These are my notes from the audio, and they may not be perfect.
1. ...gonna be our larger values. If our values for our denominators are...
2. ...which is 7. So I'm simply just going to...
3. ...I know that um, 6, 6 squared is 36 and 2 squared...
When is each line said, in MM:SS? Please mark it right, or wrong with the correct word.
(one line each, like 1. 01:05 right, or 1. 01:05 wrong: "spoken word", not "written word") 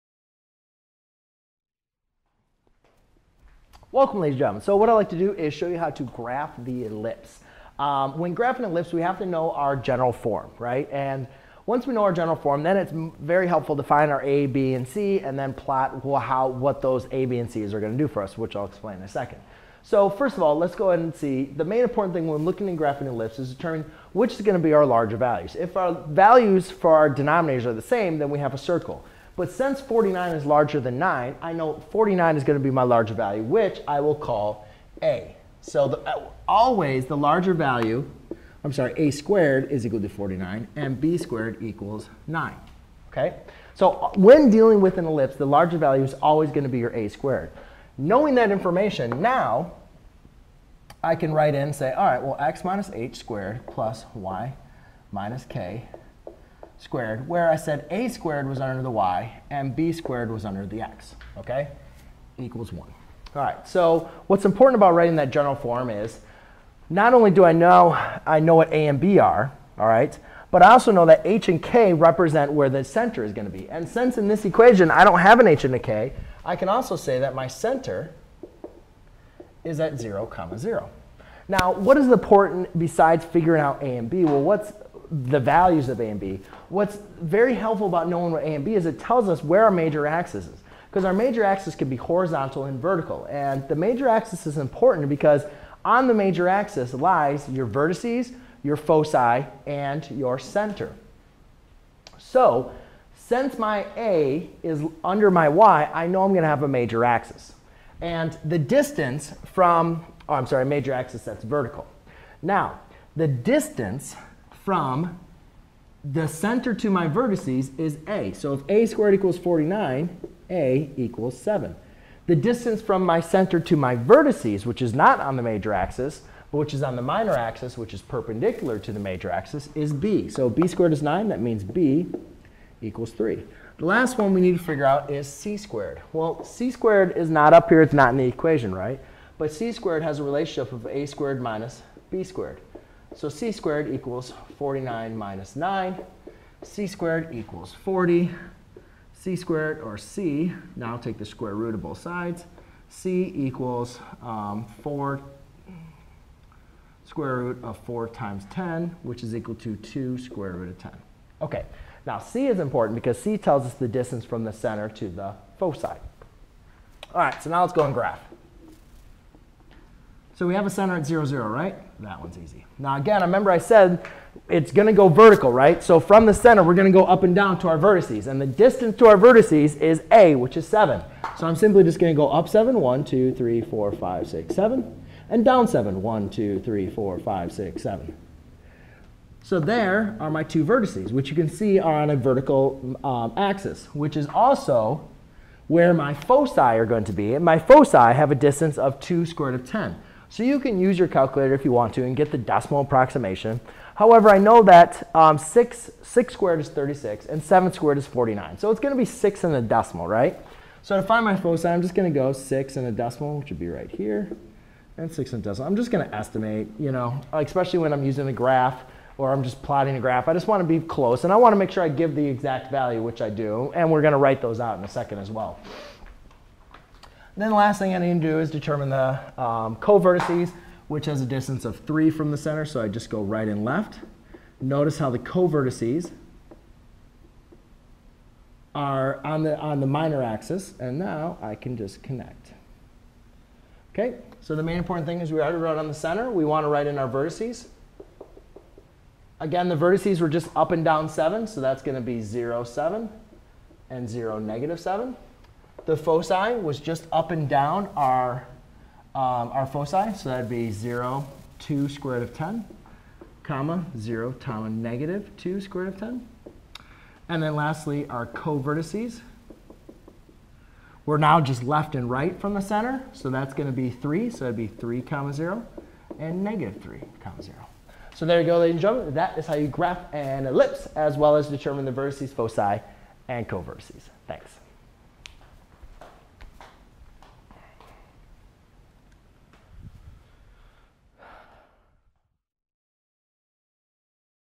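1. 00:24 right
2. 03:00 right
3. 03:24 wrong: "7", not "2".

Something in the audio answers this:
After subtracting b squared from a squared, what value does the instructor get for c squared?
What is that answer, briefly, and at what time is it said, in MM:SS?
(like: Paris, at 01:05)
40, at 02:26.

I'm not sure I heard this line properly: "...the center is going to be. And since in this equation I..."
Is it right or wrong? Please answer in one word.
right.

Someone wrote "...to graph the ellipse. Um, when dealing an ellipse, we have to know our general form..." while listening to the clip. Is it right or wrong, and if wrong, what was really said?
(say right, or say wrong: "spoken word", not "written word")
wrong: "graphing", not "dealing".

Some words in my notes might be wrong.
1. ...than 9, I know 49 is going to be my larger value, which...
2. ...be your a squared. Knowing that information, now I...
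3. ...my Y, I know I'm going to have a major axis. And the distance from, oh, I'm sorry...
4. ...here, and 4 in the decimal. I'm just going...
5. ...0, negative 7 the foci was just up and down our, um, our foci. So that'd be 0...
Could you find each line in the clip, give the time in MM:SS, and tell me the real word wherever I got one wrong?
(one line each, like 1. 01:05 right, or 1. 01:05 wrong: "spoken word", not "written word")
1. 00:30 right
2. 00:46 right
3. 01:45 right
4. 03:33 wrong: "6", not "4"
5. 04:14 right.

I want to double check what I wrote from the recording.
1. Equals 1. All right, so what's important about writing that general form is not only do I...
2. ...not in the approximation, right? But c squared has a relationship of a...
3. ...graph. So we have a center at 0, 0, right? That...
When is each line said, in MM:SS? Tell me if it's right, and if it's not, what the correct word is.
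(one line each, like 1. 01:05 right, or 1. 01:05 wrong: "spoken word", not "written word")
1. 01:02 right
2. 02:17 wrong: "equation", not "approximation"
3. 02:47 right.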